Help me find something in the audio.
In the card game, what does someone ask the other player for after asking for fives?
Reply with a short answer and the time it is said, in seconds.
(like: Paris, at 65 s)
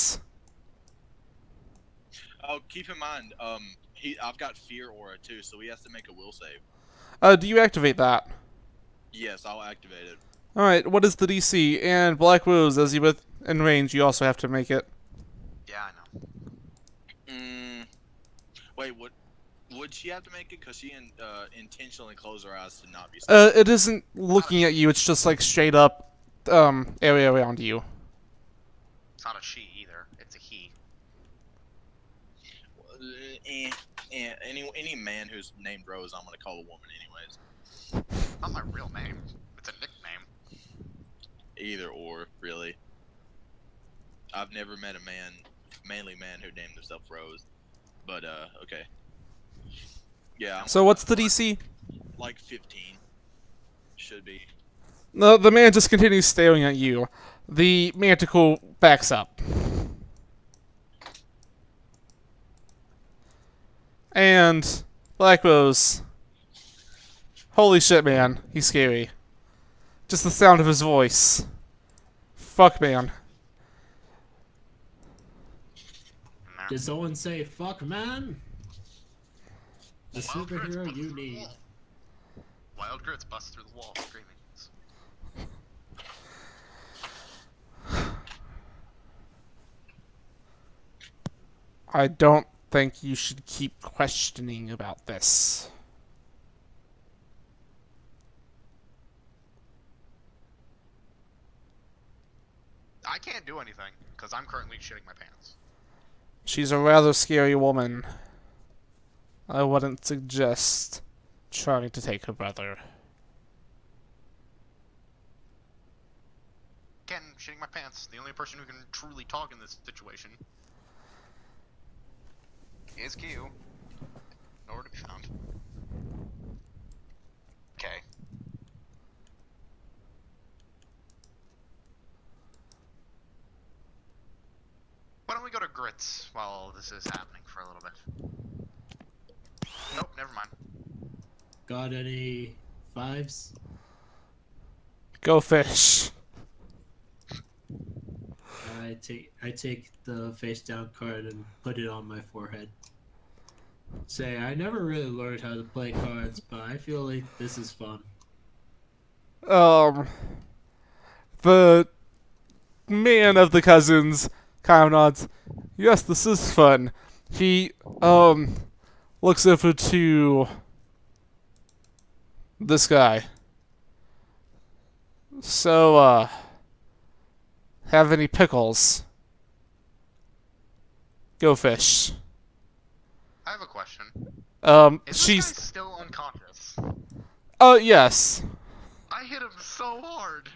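Pickles, at 178 s.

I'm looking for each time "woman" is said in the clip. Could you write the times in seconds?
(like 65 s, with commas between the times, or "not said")
36 s, 107 s.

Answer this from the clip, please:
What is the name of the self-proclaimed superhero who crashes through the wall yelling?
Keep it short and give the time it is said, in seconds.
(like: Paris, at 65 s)
Wild Grits, at 82 s.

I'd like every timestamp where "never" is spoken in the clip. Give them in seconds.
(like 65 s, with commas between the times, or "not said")
44 s, 140 s, 154 s.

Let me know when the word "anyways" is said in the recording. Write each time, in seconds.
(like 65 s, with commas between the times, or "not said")
36 s.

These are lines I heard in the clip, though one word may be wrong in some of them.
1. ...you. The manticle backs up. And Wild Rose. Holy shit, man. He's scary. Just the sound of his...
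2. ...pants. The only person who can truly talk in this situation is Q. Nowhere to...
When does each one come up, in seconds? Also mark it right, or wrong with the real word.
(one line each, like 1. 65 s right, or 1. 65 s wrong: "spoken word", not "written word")
1. 56 s wrong: "Black", not "Wild"
2. 117 s right.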